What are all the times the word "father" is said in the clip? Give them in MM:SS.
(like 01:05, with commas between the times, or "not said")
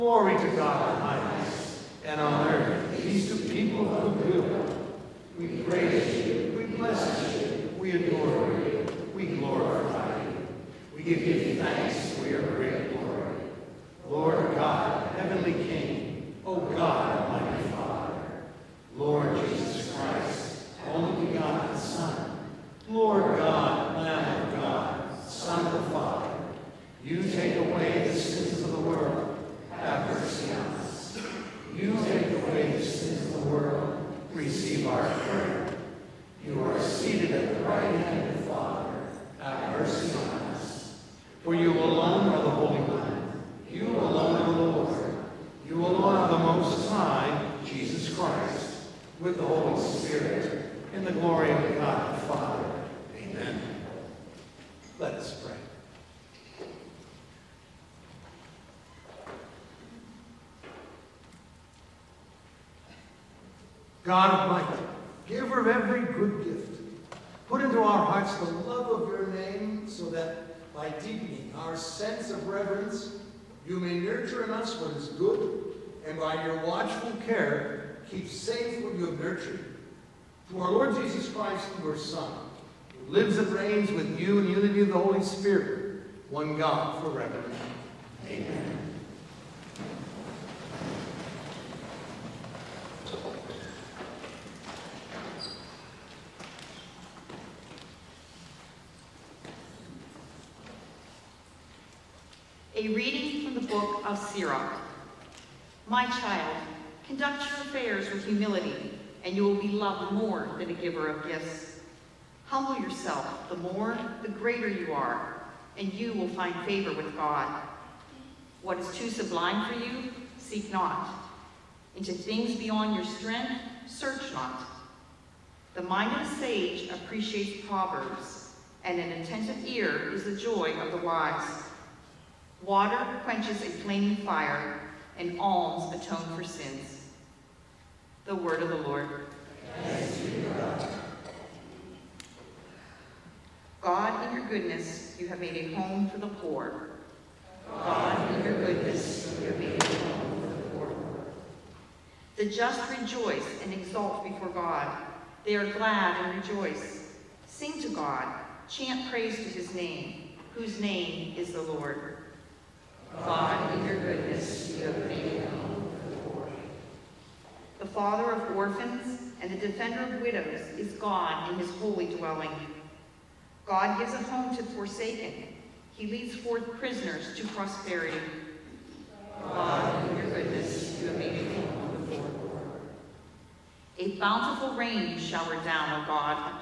00:52, 02:47.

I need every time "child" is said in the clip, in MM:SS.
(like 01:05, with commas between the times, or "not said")
01:46.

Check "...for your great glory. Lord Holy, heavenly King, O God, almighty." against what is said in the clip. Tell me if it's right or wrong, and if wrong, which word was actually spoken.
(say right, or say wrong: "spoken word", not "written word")
wrong: "God", not "Holy".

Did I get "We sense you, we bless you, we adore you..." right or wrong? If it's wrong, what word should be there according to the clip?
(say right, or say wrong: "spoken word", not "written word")
wrong: "praise", not "sense".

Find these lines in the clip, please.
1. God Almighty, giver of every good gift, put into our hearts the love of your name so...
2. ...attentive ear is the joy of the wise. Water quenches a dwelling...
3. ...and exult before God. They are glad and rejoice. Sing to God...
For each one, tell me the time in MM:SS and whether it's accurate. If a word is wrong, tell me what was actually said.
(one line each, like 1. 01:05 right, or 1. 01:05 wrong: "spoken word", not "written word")
1. 01:04 right
2. 02:09 wrong: "flaming", not "dwelling"
3. 02:33 right.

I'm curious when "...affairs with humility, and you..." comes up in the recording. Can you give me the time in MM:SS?
01:47.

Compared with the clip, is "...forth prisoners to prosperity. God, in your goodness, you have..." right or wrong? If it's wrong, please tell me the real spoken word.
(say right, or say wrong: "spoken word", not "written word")
right.